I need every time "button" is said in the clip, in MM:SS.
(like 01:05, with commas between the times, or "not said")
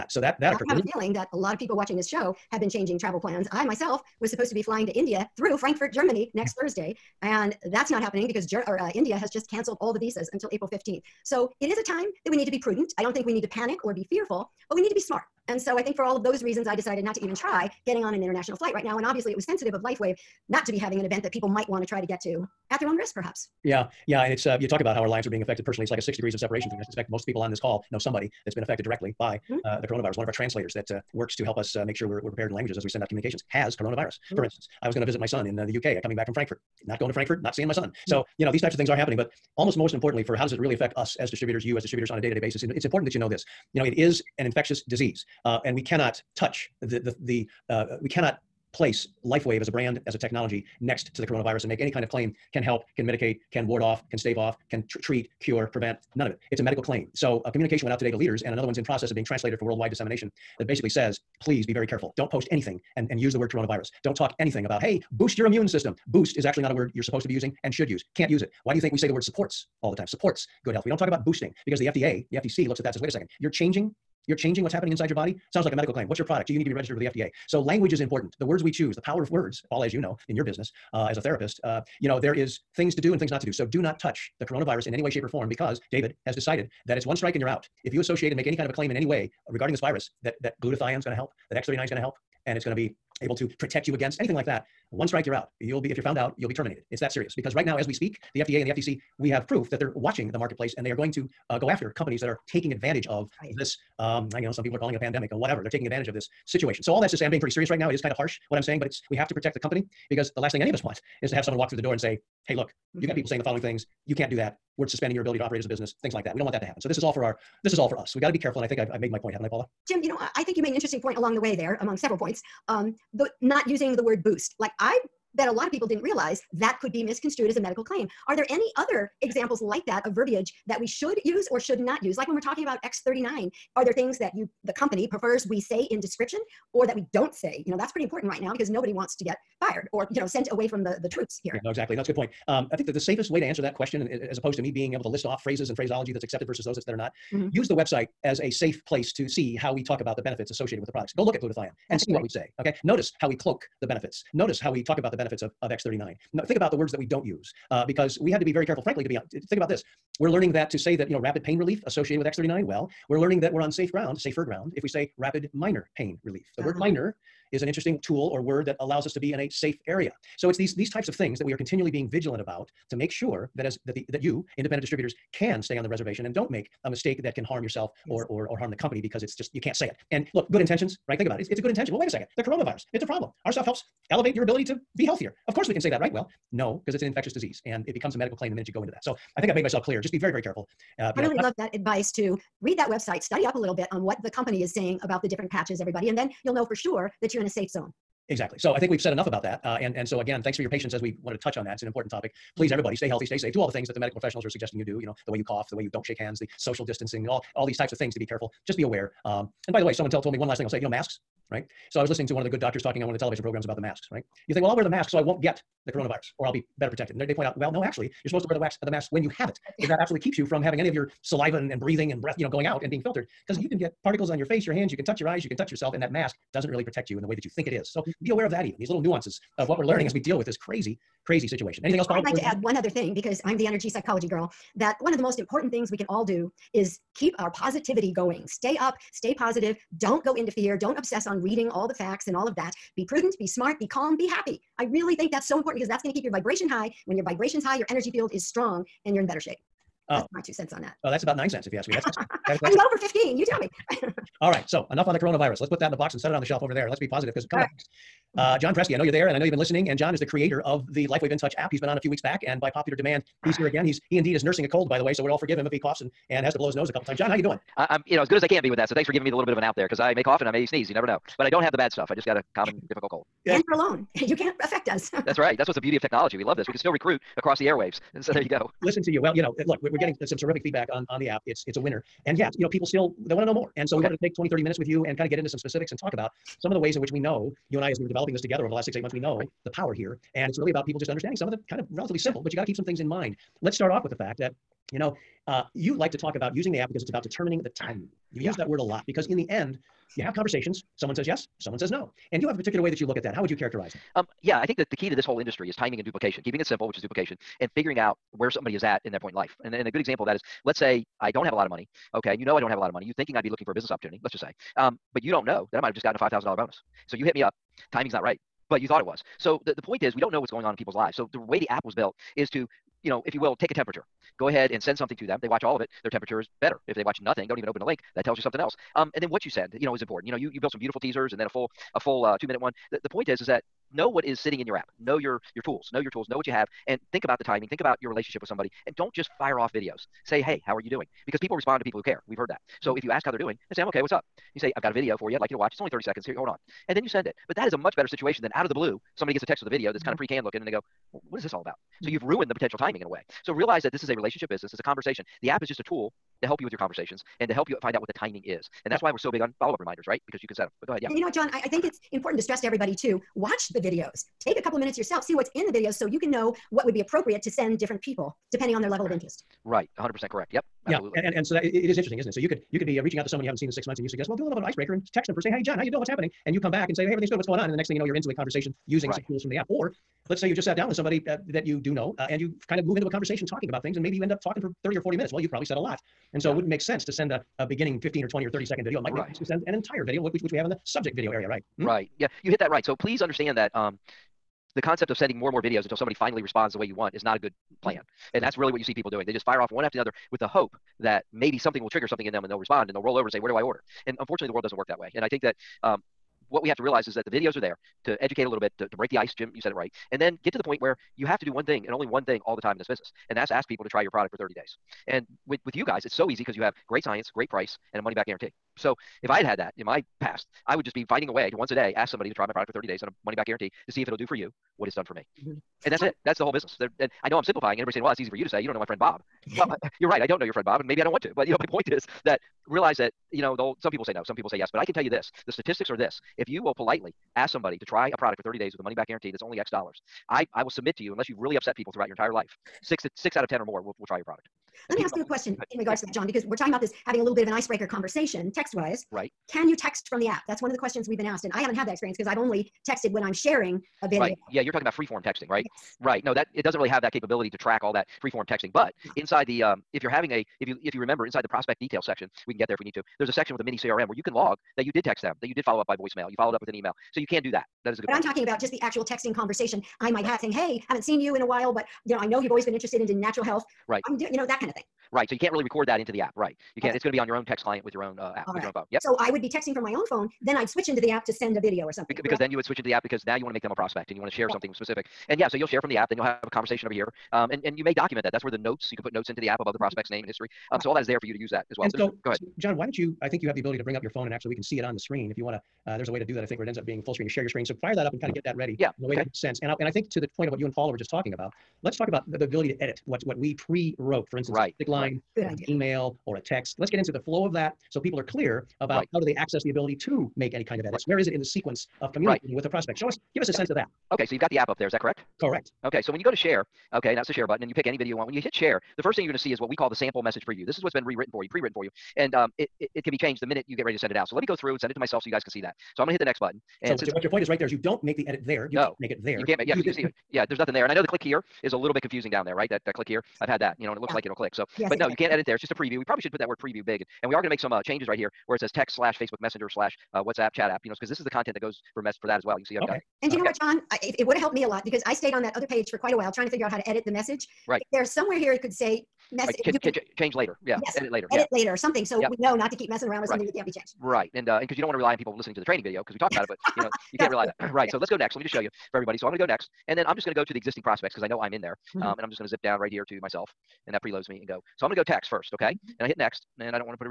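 08:37, 08:46.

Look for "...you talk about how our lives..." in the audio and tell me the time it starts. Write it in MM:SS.
00:24.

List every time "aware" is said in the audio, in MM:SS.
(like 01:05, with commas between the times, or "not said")
03:28, 03:48.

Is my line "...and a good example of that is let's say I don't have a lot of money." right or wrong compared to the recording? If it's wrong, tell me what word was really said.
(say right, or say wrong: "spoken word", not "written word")
right.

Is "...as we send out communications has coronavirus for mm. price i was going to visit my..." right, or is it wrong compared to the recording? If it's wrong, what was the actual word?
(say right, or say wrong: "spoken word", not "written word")
wrong: "instance", not "price".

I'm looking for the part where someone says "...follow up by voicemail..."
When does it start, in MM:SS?
07:45.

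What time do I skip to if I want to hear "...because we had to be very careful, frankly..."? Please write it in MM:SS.
02:37.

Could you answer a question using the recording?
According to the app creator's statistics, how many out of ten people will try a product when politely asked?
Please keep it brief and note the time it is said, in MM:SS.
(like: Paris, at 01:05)
6, at 07:23.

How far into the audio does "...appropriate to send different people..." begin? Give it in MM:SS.
06:06.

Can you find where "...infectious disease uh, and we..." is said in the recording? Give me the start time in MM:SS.
00:44.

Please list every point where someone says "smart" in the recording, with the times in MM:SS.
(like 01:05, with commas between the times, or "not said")
00:14, 04:03.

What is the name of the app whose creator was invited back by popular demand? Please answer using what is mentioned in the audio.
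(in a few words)
LifeWave InTouch.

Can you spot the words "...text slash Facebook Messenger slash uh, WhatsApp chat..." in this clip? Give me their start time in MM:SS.
08:58.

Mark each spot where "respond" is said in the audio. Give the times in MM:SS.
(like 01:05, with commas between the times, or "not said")
05:41, 06:36, 06:42.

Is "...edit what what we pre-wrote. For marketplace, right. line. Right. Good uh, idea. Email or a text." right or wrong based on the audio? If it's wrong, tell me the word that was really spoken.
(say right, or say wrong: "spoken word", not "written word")
wrong: "instance", not "marketplace".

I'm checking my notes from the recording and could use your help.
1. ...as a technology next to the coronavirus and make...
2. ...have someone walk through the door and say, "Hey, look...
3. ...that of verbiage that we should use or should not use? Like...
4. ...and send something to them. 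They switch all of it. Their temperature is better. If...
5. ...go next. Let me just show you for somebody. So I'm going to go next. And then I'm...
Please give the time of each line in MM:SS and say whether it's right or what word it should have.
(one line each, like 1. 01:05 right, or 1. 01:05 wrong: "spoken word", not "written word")
1. 00:50 right
2. 01:51 right
3. 02:09 right
4. 05:24 wrong: "watch", not "switch"
5. 09:18 wrong: "everybody", not "somebody".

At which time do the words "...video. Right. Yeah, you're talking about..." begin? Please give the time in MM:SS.
07:34.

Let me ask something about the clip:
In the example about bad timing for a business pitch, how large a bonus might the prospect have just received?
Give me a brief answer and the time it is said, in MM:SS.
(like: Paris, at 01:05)
$5,000, at 05:16.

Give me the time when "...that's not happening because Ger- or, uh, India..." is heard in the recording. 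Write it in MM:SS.
00:07.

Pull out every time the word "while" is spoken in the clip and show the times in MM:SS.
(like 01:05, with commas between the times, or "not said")
07:51, 09:06.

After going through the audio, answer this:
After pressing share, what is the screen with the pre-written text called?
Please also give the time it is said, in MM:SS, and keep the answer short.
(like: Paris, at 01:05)
sample message preview, at 08:39.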